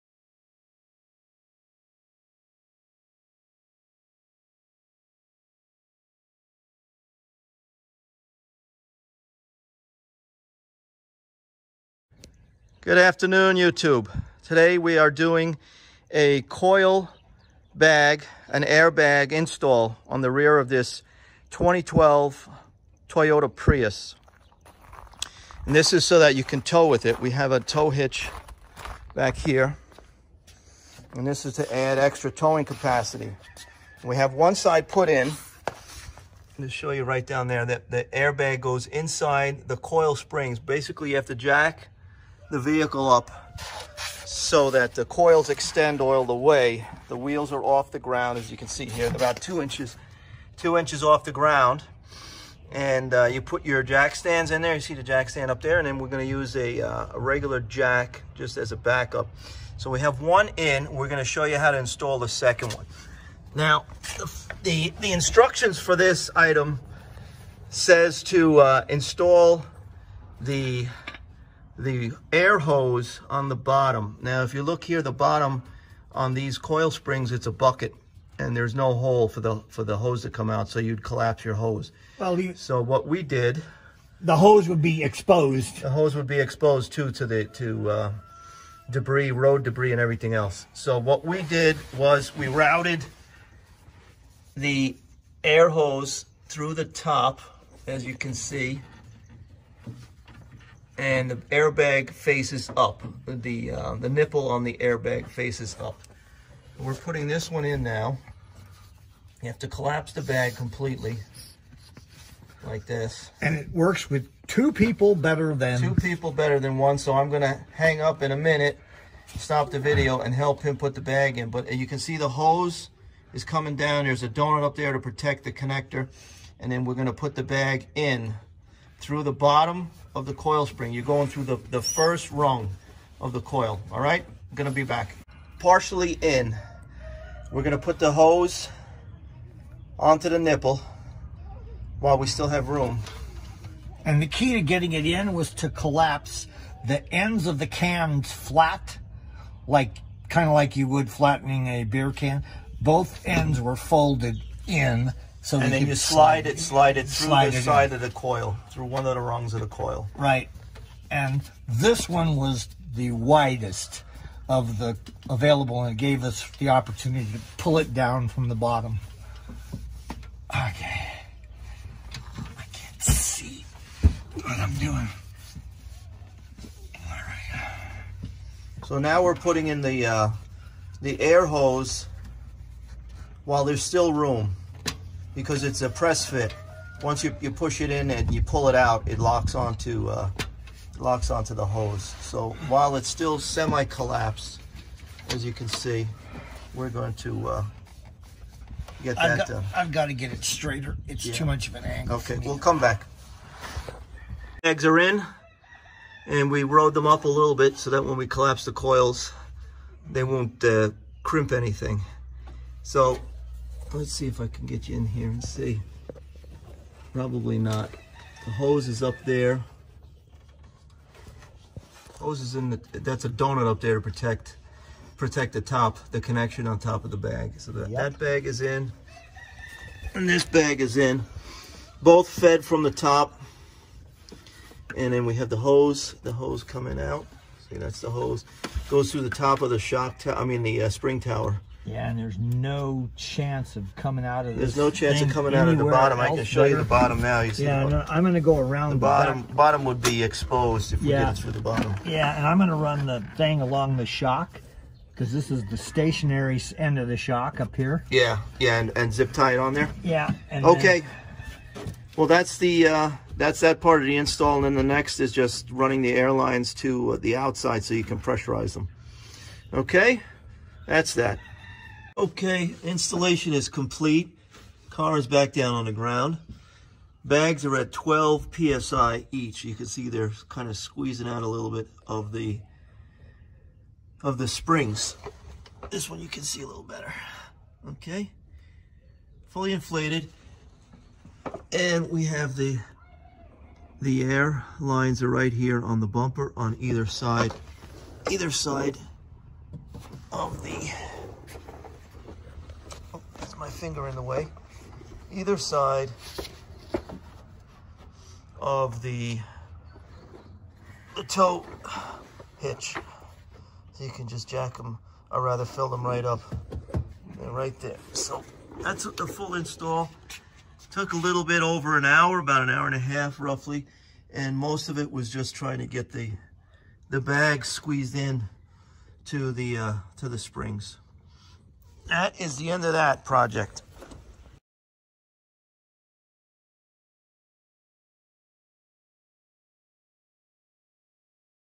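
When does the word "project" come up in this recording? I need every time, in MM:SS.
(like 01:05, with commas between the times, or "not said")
05:33.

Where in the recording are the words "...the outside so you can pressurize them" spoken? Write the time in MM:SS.
04:27.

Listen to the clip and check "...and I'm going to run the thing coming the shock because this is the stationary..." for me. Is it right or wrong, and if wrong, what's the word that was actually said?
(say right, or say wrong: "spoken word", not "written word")
wrong: "along", not "coming".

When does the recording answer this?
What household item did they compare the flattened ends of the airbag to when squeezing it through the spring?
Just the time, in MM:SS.
02:31.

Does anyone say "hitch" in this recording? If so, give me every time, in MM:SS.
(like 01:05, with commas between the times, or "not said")
00:27, 05:12.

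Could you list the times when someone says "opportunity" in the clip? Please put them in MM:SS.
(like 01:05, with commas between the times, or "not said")
02:46.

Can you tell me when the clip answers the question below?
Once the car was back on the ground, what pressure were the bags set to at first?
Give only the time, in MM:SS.
04:37.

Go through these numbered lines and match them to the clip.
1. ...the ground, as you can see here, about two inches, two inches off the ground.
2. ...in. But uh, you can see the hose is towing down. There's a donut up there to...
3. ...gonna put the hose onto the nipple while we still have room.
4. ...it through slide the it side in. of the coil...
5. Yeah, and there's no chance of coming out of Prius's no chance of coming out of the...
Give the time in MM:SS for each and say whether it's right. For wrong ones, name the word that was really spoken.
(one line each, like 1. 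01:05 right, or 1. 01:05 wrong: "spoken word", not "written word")
1. 00:47 right
2. 02:01 wrong: "coming", not "towing"
3. 02:17 right
4. 02:36 right
5. 04:01 wrong: "There", not "Prius".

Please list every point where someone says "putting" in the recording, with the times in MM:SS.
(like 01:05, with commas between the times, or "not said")
01:46, 02:59.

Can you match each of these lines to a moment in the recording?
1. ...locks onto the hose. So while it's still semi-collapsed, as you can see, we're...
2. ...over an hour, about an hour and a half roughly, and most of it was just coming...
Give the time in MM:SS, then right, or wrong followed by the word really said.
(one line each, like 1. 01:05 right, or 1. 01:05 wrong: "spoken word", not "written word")
1. 03:10 right
2. 05:21 wrong: "trying", not "coming".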